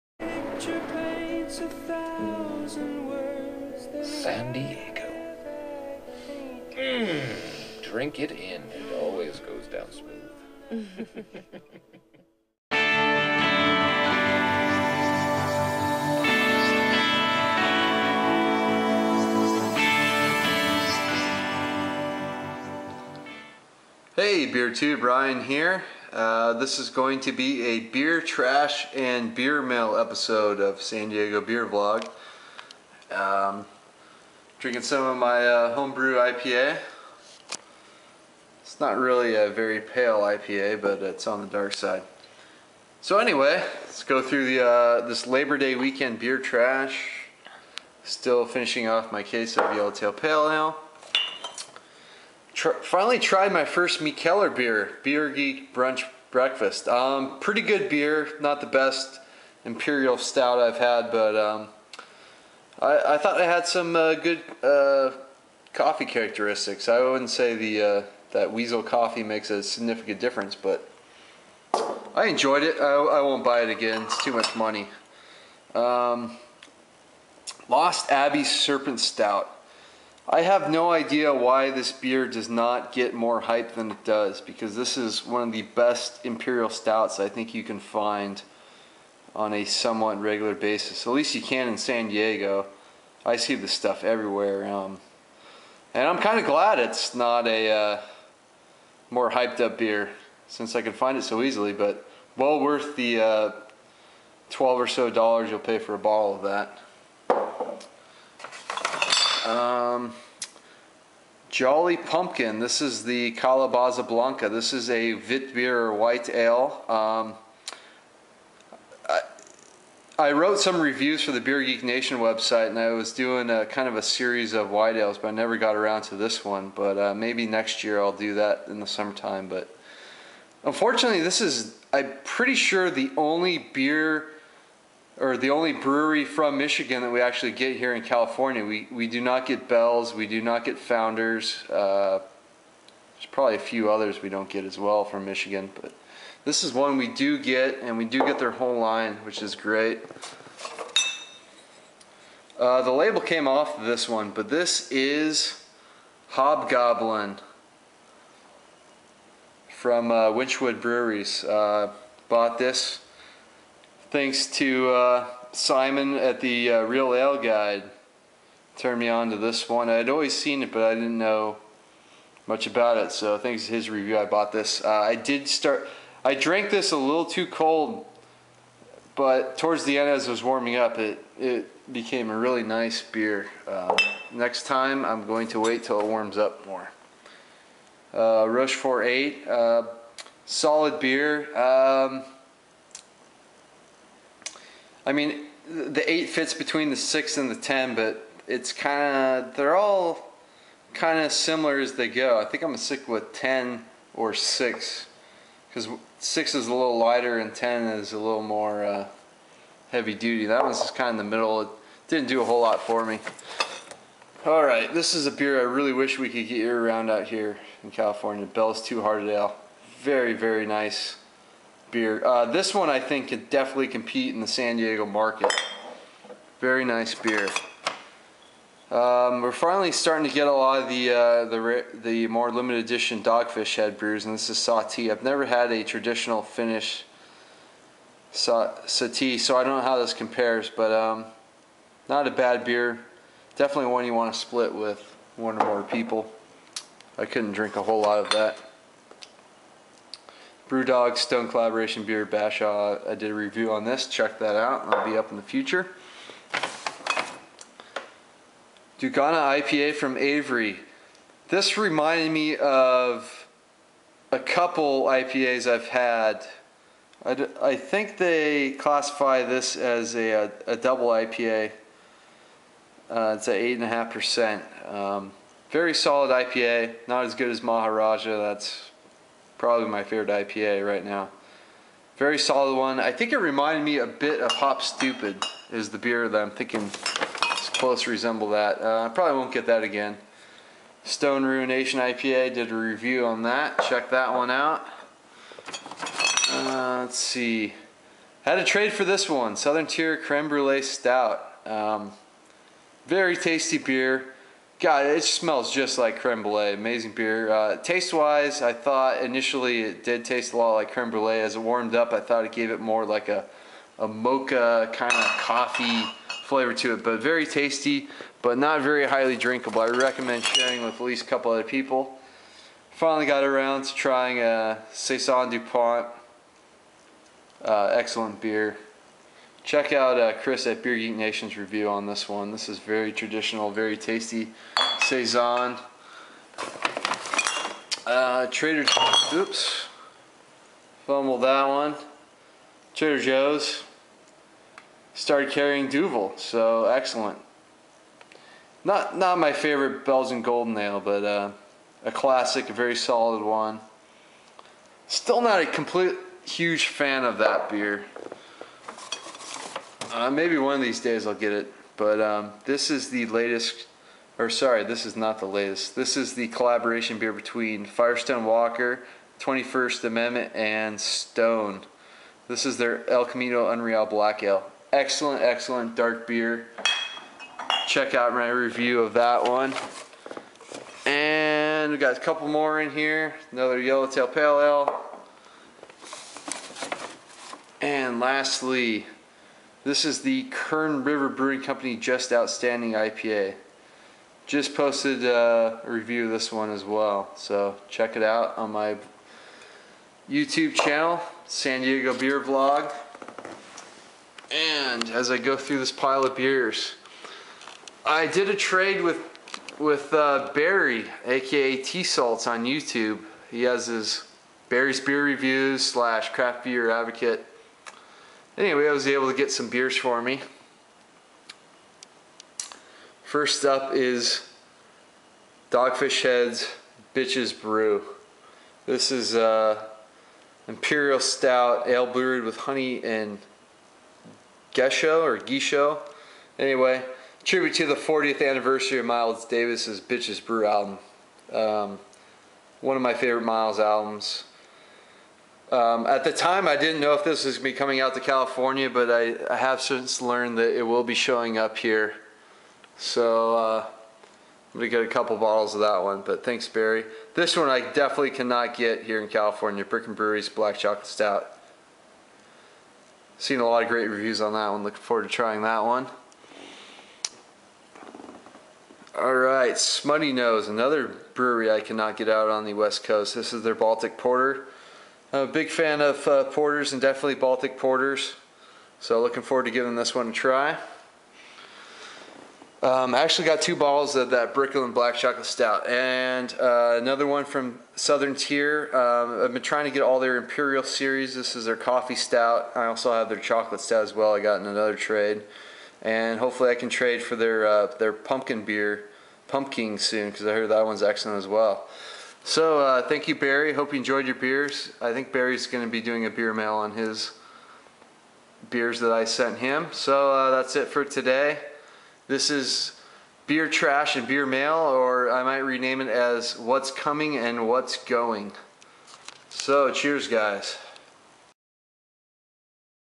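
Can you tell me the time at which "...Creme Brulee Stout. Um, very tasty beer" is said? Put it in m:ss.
5:00.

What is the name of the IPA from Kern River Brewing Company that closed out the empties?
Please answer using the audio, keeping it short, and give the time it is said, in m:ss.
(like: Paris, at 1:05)
Just Outstanding IPA, at 6:31.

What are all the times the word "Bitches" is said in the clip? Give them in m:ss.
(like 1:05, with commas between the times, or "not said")
7:07, 7:20.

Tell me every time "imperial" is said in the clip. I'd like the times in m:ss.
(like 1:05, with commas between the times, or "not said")
0:59, 1:26, 7:10, 8:10.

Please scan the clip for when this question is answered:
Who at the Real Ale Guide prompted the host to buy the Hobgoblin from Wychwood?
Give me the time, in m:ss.
2:45.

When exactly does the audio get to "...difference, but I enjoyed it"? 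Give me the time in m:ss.
1:10.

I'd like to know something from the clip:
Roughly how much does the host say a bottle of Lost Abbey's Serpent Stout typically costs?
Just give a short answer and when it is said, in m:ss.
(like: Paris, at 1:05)
12 dollars, at 1:44.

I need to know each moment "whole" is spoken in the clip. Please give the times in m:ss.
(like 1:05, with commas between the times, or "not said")
2:28, 3:32, 4:07.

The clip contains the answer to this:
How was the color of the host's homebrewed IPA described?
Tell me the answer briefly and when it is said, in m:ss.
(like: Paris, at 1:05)
on the dark side, at 0:41.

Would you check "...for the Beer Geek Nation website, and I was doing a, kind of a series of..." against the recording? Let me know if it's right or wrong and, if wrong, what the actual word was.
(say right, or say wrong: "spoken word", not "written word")
right.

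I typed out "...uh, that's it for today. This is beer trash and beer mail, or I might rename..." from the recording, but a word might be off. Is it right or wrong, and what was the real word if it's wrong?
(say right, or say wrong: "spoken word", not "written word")
right.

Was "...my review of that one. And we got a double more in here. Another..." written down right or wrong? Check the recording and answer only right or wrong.
wrong.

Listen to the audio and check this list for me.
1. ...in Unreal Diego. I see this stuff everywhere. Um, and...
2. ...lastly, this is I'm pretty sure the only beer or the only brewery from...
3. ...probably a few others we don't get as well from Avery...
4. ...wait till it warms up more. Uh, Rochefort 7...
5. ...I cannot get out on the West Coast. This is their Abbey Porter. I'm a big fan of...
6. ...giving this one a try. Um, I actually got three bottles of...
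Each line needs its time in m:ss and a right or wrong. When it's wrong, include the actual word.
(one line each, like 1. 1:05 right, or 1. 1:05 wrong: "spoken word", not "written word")
1. 1:31 wrong: "San", not "Unreal"
2. 2:10 wrong: "unfortunately", not "lastly"
3. 2:23 wrong: "Michigan", not "Avery"
4. 3:05 wrong: "8", not "7"
5. 7:51 wrong: "Baltic", not "Abbey"
6. 7:59 wrong: "two", not "three".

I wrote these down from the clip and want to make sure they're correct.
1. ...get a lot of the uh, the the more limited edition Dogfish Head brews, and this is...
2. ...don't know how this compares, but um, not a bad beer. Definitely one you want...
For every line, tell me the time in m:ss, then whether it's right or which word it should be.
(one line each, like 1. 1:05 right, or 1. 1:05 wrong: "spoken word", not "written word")
1. 3:50 right
2. 3:59 right.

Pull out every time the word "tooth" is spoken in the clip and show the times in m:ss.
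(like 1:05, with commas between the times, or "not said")
not said.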